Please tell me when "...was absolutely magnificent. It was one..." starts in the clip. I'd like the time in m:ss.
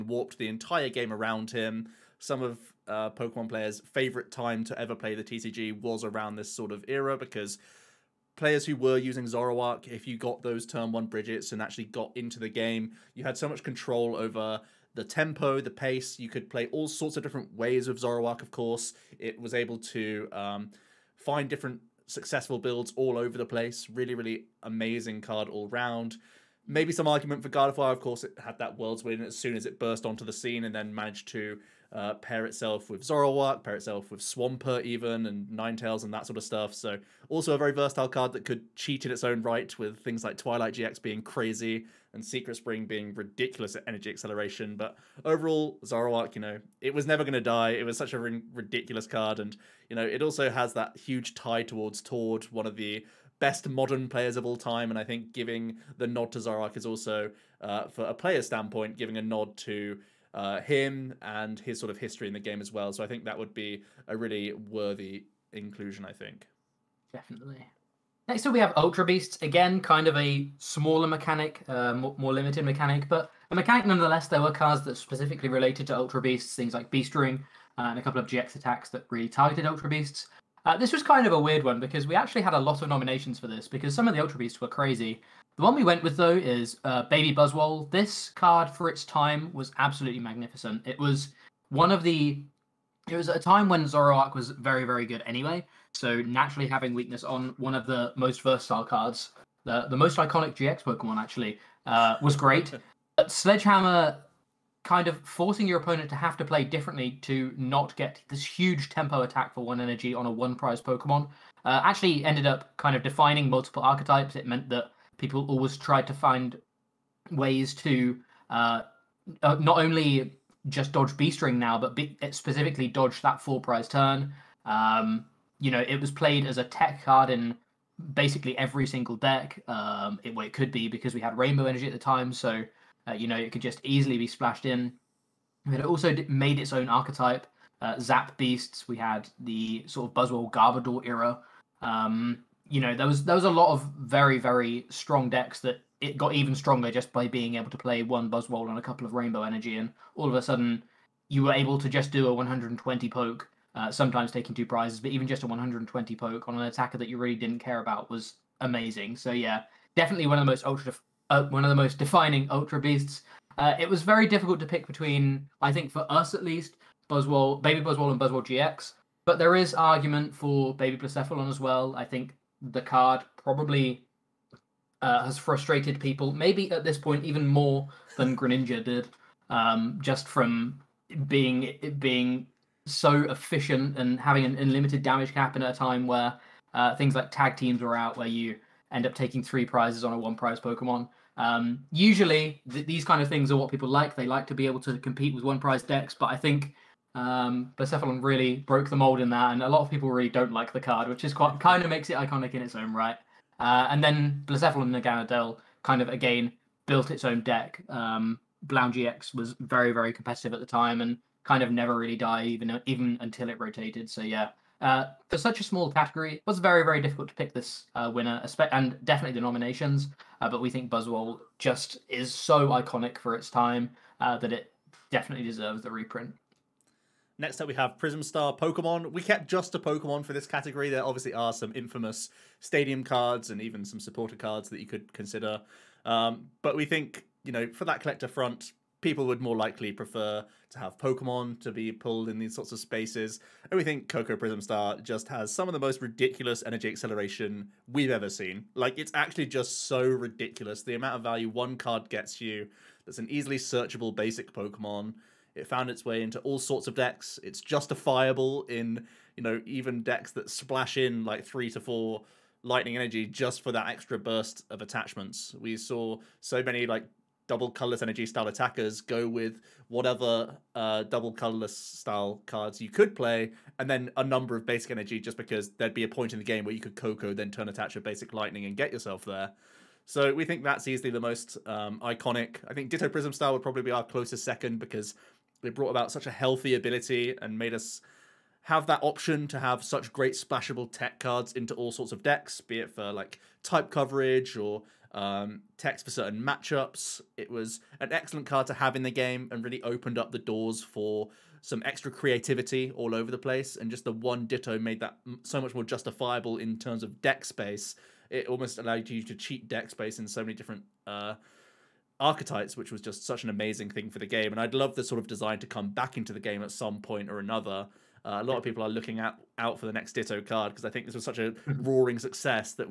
1:29.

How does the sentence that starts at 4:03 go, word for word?
And we think Koko Prism Star just has some of the most ridiculous energy acceleration we've ever seen.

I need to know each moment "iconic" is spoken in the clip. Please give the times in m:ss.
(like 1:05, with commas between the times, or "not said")
1:40, 3:22, 3:42, 4:41.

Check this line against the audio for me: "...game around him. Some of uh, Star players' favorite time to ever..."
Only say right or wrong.
wrong.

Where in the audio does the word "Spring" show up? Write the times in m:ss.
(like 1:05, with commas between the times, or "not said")
0:42.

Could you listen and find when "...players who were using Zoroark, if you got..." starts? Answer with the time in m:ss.
0:08.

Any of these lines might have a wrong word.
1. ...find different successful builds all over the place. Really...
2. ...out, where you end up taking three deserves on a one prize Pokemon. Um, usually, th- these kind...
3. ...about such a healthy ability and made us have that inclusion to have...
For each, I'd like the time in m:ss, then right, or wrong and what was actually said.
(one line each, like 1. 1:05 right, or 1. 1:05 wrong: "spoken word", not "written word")
1. 0:21 right
2. 3:07 wrong: "prizes", not "deserves"
3. 4:45 wrong: "option", not "inclusion".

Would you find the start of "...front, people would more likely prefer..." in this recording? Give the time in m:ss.
3:58.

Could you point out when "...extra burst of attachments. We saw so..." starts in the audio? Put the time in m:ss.
4:23.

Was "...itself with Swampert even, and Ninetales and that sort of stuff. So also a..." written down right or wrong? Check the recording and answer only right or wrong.
right.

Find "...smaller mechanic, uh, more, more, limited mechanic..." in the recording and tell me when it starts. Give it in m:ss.
1:10.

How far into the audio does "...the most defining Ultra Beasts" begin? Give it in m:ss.
2:41.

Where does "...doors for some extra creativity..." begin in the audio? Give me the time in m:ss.
5:00.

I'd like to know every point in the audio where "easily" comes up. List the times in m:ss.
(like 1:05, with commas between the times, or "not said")
2:13, 4:13, 4:40.